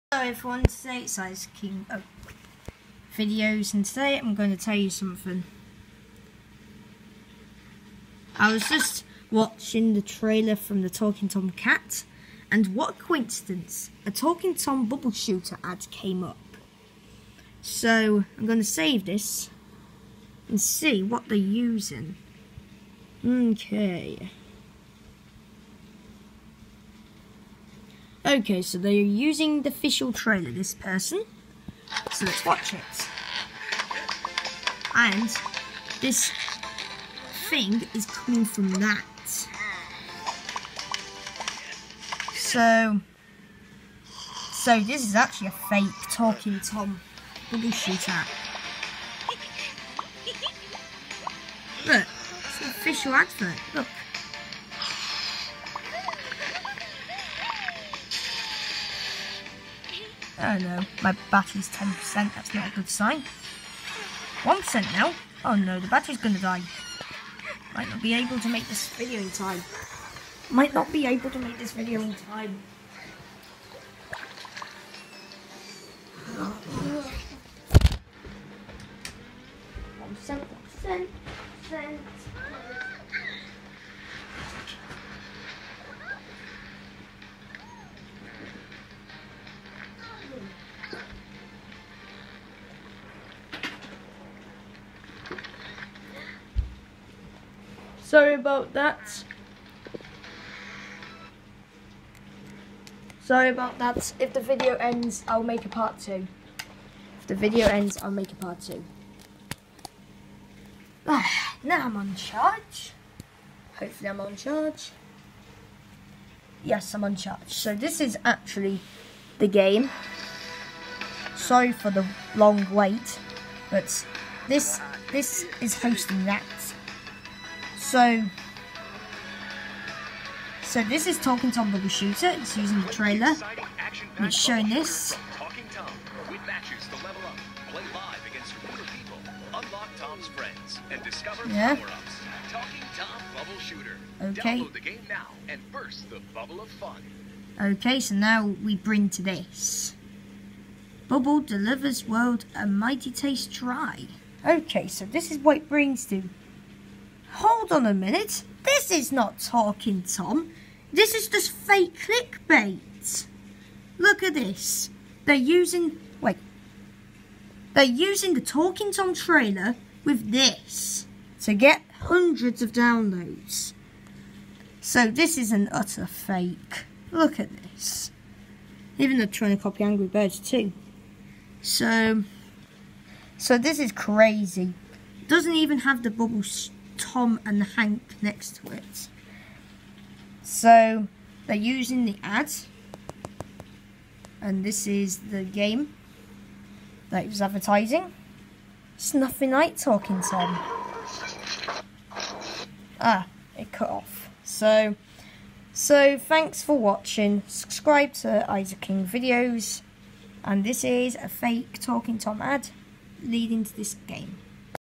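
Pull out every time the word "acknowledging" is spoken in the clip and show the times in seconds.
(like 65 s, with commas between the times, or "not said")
not said.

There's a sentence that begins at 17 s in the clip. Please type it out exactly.
So I'm going to save this and see what they're using.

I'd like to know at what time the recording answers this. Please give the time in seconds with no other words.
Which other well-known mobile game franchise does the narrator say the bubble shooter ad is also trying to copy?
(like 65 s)
179 s.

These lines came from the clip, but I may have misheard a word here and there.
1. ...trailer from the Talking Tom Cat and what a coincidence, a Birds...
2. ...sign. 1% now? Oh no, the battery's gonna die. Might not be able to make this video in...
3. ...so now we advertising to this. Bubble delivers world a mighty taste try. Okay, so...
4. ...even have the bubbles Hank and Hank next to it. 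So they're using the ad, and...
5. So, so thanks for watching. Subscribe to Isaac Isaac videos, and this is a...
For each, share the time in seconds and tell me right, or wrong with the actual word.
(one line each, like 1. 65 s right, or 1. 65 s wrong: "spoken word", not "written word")
1. 10 s wrong: "Talking", not "Birds"
2. 62 s right
3. 147 s wrong: "bring", not "advertising"
4. 185 s wrong: "Tom", not "Hank"
5. 204 s wrong: "King", not "Isaac".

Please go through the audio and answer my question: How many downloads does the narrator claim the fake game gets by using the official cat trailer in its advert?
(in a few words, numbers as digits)
hundreds.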